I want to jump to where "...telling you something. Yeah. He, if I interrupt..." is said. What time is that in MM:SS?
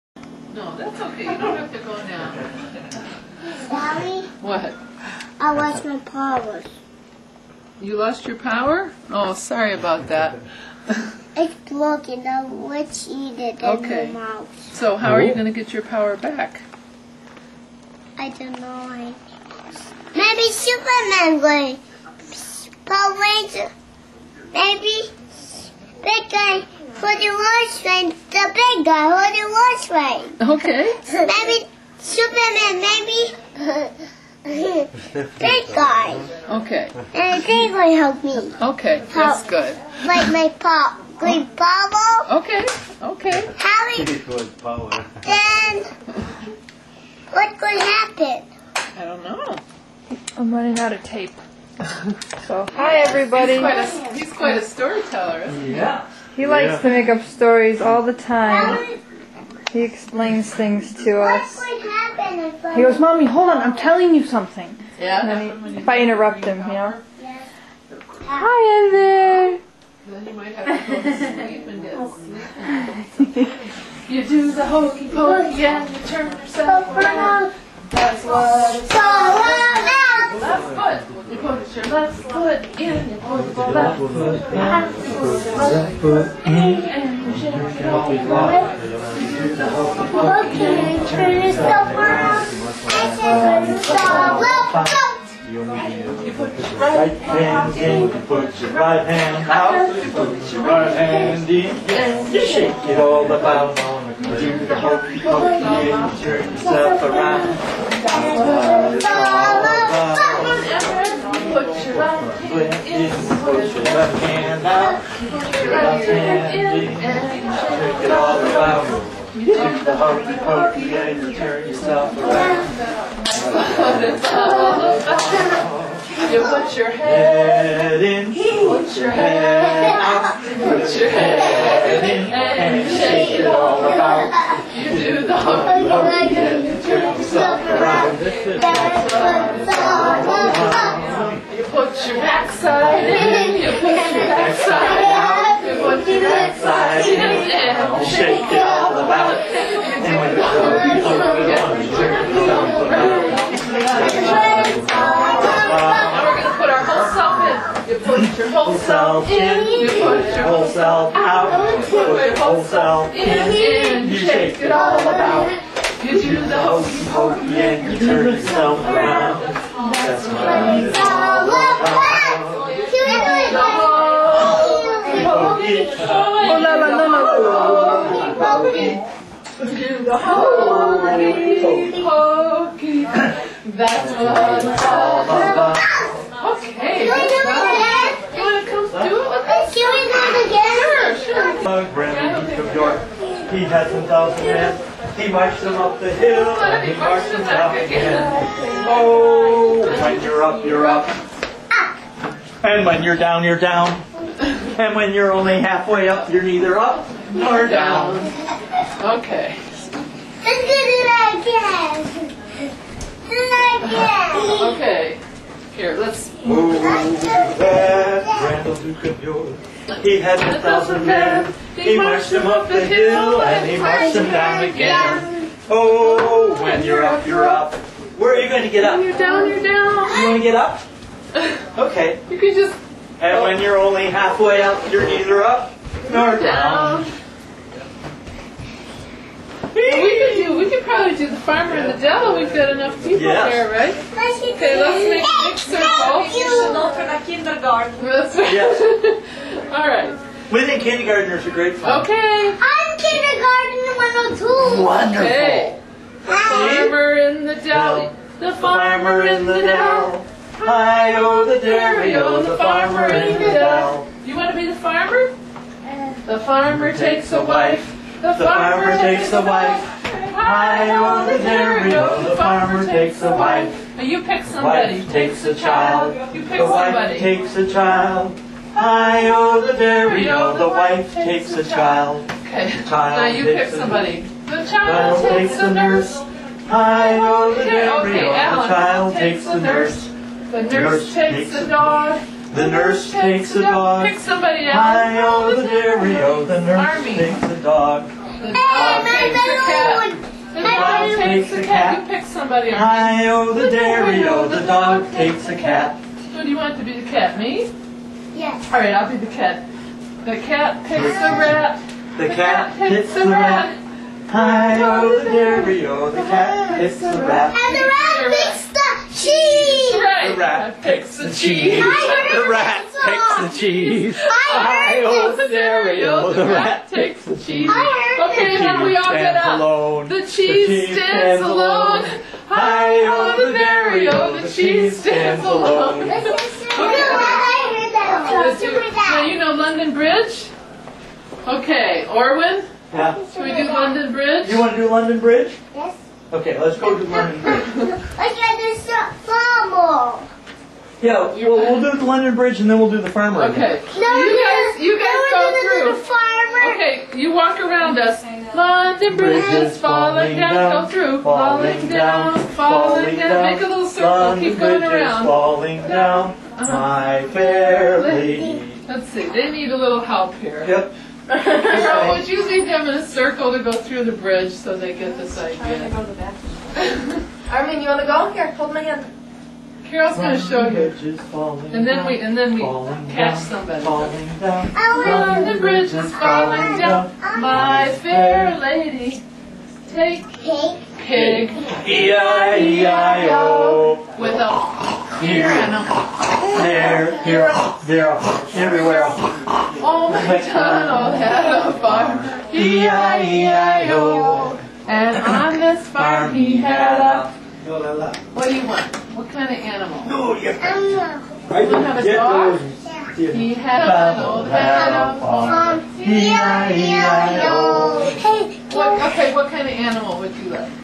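01:03.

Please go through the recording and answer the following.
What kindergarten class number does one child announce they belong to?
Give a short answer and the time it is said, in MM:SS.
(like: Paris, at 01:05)
102, at 04:14.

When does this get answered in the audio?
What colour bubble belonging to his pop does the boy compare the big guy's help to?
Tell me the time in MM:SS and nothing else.
00:41.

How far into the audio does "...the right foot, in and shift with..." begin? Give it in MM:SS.
01:25.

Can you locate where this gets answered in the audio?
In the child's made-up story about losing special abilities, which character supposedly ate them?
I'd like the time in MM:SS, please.
00:12.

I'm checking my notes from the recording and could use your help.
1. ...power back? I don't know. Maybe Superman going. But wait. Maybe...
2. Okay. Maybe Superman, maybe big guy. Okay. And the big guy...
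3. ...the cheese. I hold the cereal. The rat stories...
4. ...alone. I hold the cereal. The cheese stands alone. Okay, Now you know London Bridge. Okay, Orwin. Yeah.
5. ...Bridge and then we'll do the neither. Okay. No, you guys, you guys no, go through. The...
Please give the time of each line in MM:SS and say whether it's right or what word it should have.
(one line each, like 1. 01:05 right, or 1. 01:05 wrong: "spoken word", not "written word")
1. 00:15 right
2. 00:30 right
3. 05:23 wrong: "takes", not "stories"
4. 05:31 right
5. 05:52 wrong: "farmer", not "neither".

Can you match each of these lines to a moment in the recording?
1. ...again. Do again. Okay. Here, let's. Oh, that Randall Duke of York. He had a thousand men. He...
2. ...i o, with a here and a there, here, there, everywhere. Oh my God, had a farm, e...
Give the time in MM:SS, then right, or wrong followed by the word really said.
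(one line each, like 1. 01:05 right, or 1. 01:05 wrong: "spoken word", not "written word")
1. 03:31 right
2. 06:32 right.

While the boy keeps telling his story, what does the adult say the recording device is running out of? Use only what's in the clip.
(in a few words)
tape.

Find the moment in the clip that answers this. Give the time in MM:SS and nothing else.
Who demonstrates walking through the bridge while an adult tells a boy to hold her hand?
06:19.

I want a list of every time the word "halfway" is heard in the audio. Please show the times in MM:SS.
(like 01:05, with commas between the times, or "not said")
03:25, 03:54.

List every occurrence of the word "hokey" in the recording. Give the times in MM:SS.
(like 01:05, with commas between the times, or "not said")
01:14, 01:44, 01:59, 02:15, 02:46, 03:00.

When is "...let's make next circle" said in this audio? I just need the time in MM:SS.
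04:04.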